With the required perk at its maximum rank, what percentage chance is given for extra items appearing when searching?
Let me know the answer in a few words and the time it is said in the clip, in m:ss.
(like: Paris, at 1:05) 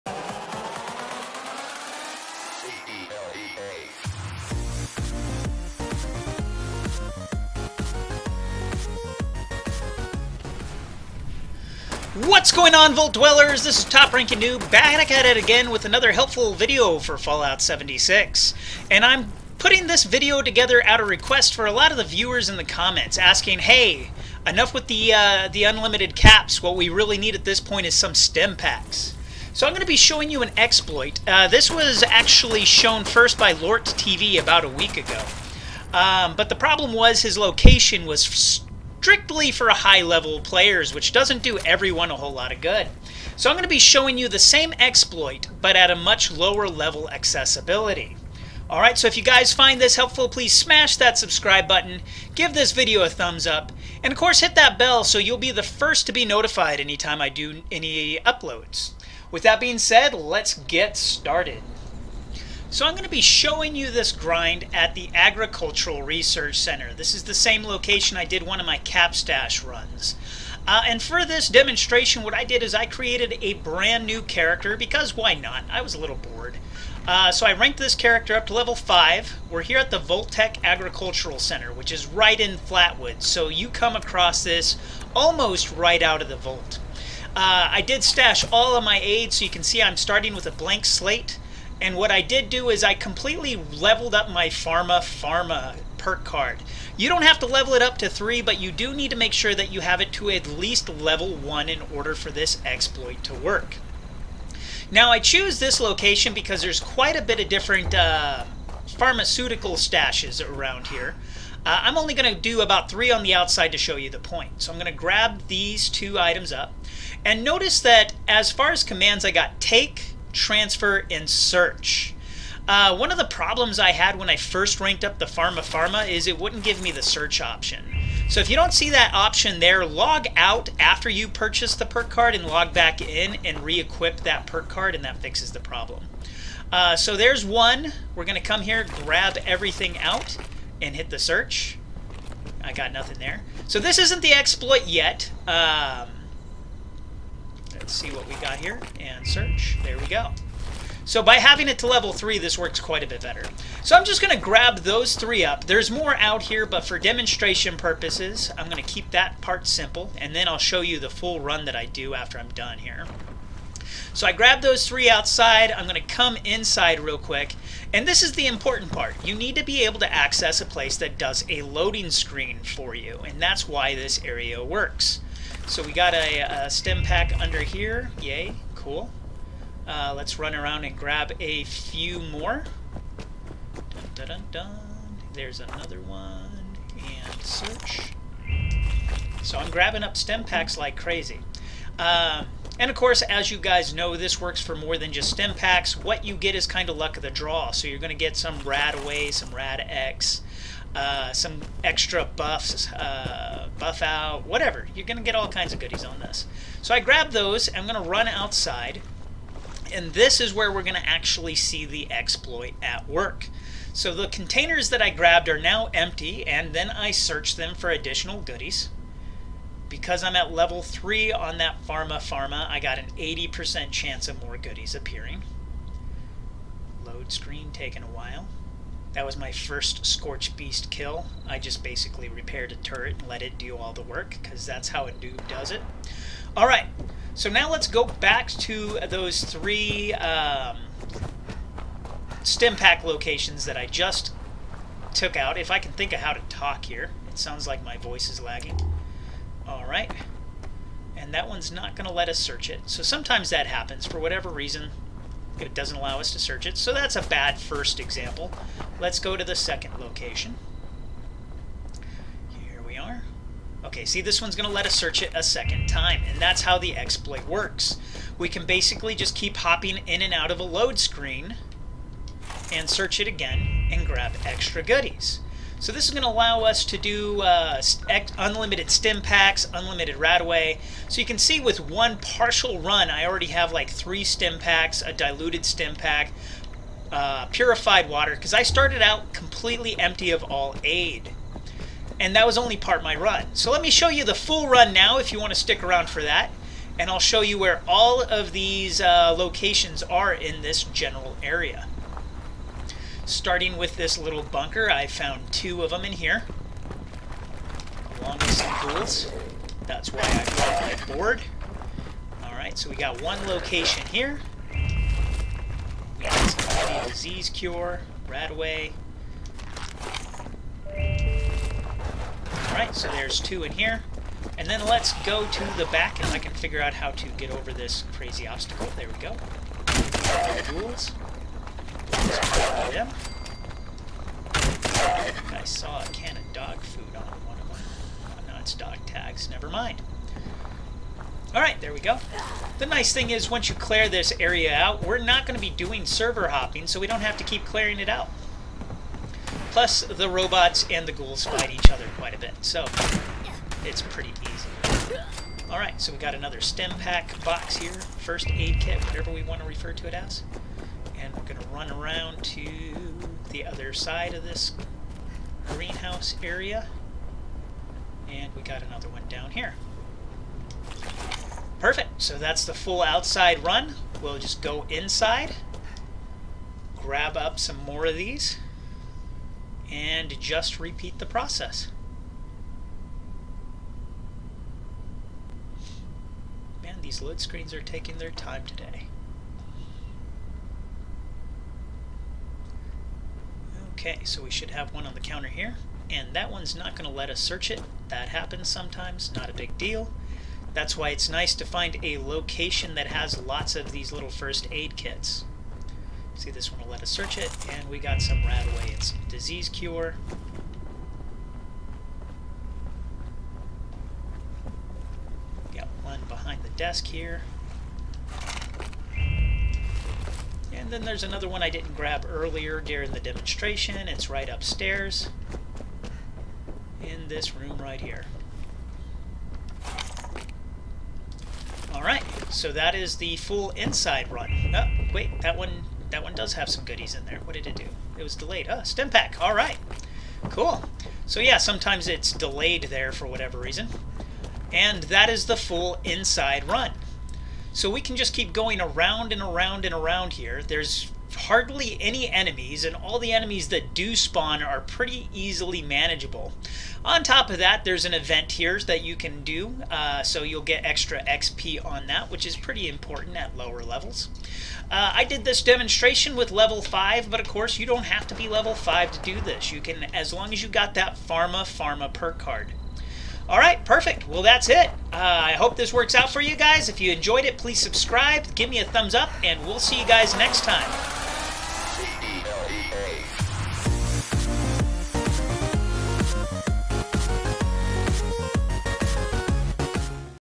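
80%, at 3:43.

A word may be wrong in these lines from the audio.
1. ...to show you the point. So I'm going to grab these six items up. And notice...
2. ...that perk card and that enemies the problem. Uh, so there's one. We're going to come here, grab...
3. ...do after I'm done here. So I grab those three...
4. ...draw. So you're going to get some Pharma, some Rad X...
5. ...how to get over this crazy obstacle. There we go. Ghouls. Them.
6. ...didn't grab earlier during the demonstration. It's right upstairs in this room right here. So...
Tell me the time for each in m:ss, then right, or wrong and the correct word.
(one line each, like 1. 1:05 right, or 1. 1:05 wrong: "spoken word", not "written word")
1. 1:53 wrong: "two", not "six"
2. 2:14 wrong: "fixes", not "enemies"
3. 2:41 right
4. 3:17 wrong: "RadAway", not "Pharma"
5. 5:26 right
6. 7:01 right.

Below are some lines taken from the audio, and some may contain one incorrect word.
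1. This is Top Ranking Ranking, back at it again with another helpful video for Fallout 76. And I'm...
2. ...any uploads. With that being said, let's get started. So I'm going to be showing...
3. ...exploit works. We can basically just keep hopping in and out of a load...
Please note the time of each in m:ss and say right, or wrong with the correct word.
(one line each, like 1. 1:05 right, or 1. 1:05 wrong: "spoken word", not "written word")
1. 0:13 wrong: "Noob", not "Ranking"
2. 0:57 right
3. 4:26 right.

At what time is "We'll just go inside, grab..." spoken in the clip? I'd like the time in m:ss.
6:14.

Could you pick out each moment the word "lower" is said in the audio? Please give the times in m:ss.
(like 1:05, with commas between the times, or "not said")
0:46, 7:43.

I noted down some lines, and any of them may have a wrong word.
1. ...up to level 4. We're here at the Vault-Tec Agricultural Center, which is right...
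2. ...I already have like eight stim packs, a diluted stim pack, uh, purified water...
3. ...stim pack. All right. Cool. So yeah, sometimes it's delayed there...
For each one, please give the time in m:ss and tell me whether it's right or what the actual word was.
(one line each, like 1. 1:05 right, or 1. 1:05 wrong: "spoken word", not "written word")
1. 1:18 wrong: "5", not "4"
2. 4:43 wrong: "three", not "eight"
3. 7:18 right.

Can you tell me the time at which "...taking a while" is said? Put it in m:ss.
3:47.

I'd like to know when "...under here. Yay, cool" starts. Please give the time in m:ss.
2:57.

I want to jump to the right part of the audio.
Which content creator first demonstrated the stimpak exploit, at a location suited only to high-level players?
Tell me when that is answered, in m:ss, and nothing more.
0:33.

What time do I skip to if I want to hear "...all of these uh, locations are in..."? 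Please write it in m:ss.
4:57.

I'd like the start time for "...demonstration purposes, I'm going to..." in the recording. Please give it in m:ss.
2:36.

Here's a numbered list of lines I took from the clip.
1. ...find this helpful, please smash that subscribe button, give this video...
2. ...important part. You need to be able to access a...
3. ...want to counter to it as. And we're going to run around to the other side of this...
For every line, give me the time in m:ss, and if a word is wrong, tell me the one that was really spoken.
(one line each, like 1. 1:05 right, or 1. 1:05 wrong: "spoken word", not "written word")
1. 0:49 right
2. 2:48 right
3. 5:59 wrong: "refer", not "counter".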